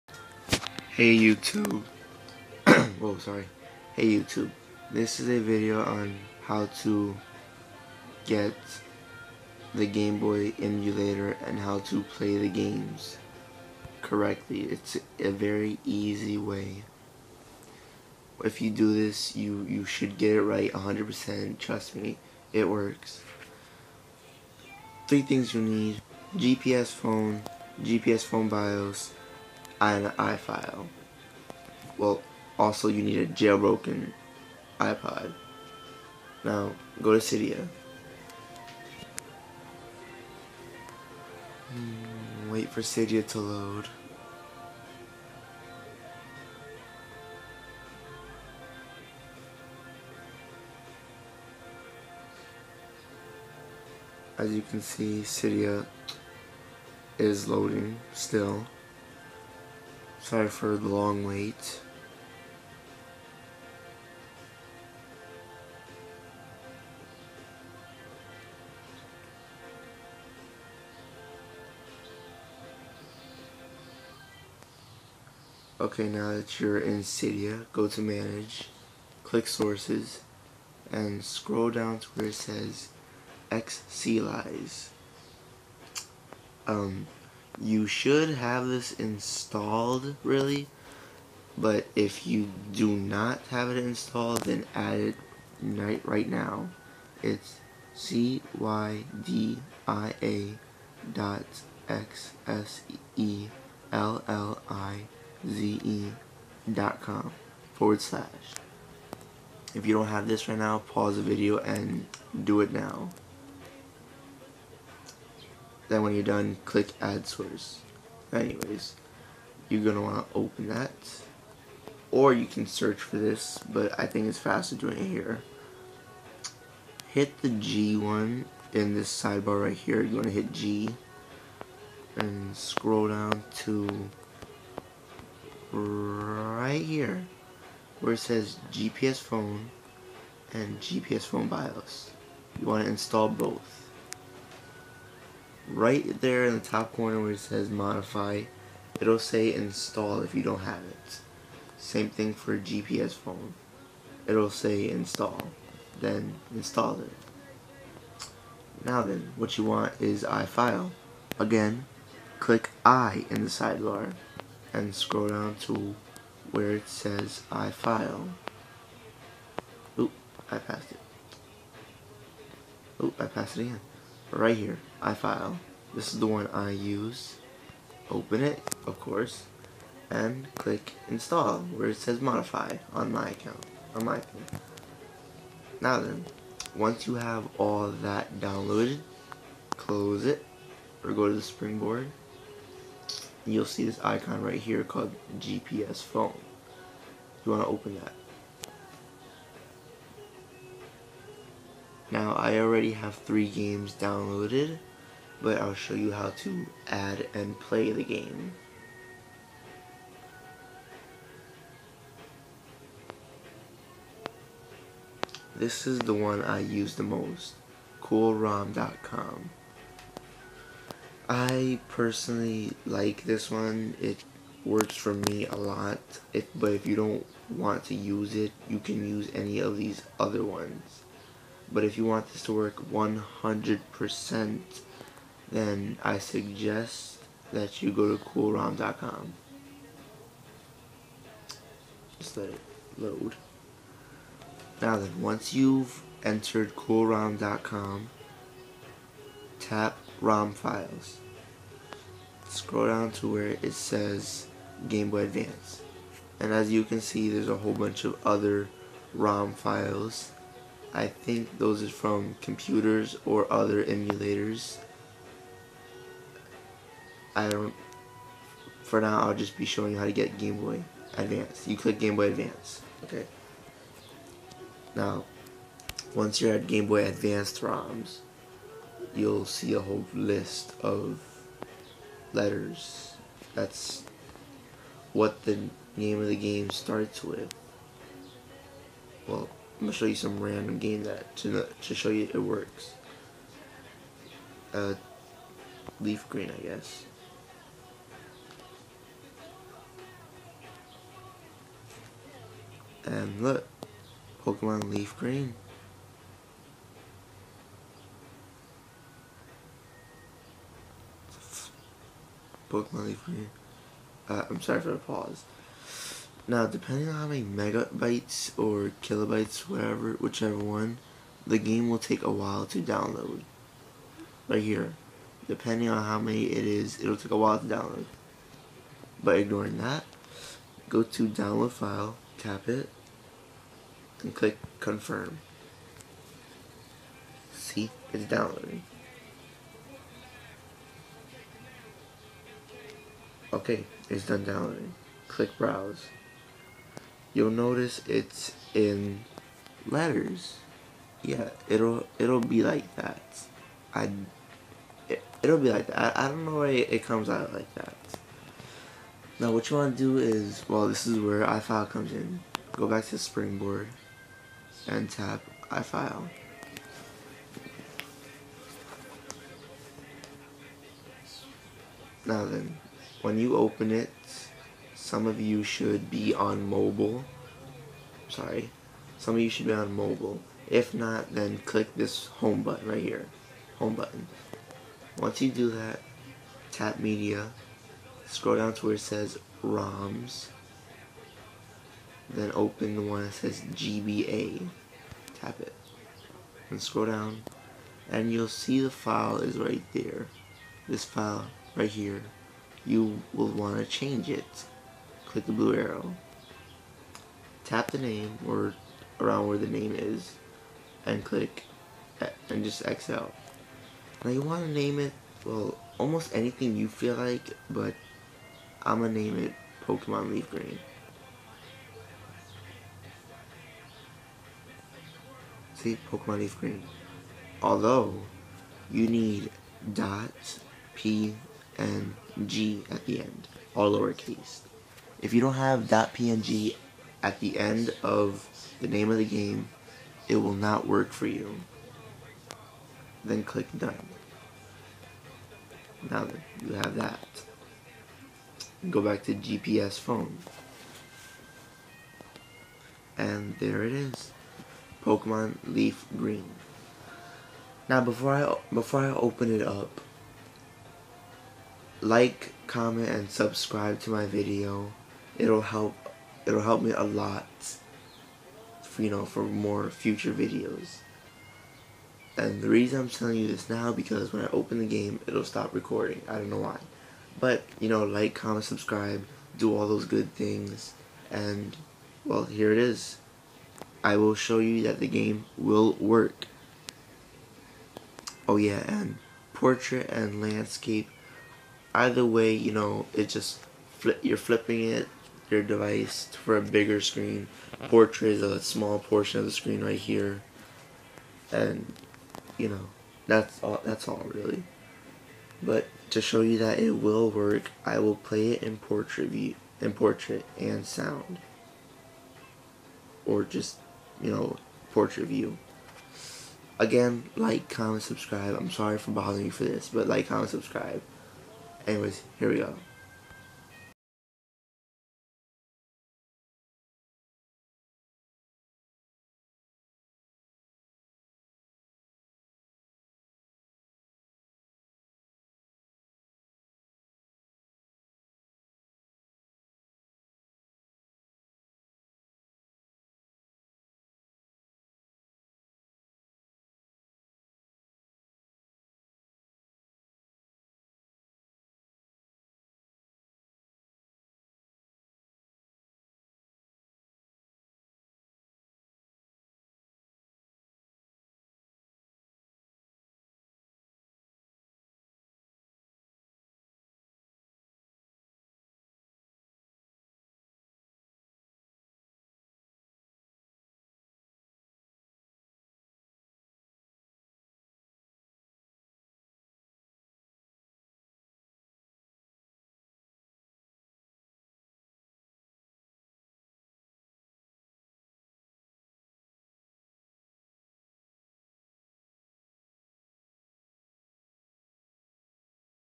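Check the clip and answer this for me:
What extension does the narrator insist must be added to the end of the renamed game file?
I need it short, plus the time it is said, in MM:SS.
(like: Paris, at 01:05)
.png, at 07:15.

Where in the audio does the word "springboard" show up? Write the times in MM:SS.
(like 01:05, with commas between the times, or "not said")
03:11, 06:03.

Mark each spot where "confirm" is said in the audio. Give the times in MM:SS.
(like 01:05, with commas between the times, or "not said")
05:34.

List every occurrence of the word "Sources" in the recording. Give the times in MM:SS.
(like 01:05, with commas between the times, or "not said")
01:19, 01:57.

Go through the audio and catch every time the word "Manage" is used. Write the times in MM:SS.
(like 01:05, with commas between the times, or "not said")
01:18.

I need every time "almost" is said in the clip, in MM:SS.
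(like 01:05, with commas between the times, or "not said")
06:55.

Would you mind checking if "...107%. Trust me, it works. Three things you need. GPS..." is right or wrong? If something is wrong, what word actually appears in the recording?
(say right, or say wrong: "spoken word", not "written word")
wrong: "100", not "107".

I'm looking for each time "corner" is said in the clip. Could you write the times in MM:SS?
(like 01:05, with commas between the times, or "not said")
02:26.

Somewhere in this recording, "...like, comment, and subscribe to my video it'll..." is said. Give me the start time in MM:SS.
07:42.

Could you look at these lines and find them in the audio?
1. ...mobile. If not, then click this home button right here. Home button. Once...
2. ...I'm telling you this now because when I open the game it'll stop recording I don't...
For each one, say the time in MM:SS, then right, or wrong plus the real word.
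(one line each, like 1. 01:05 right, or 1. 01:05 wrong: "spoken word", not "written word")
1. 06:19 right
2. 07:52 right.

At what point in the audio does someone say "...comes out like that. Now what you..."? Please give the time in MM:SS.
05:57.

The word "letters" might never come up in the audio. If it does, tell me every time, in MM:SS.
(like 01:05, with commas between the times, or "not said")
04:42, 05:49.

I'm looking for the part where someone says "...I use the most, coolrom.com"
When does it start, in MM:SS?
03:36.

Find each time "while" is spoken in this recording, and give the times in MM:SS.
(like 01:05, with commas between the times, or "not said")
05:22, 05:27.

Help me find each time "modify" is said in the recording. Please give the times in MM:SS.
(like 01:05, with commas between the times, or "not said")
02:27, 03:02.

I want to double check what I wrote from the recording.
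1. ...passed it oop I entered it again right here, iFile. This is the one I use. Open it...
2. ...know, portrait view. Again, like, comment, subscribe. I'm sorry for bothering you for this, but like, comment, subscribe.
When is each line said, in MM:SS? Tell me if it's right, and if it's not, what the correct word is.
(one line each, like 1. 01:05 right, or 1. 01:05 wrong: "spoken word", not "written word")
1. 02:50 wrong: "passed", not "entered"
2. 08:34 right.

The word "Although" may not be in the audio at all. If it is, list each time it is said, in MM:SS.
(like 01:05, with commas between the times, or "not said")
07:07.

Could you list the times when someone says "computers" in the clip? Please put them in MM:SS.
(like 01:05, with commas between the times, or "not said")
04:22.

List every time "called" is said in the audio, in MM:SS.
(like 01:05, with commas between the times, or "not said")
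03:14.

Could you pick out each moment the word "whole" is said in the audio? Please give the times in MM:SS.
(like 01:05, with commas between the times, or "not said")
04:17, 04:39.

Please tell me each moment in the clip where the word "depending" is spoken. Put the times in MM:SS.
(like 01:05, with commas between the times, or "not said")
05:16, 05:25.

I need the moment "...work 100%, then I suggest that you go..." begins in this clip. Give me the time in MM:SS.
03:52.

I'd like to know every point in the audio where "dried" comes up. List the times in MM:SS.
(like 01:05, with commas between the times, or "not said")
not said.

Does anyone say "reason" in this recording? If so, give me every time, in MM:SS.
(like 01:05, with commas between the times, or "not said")
07:52.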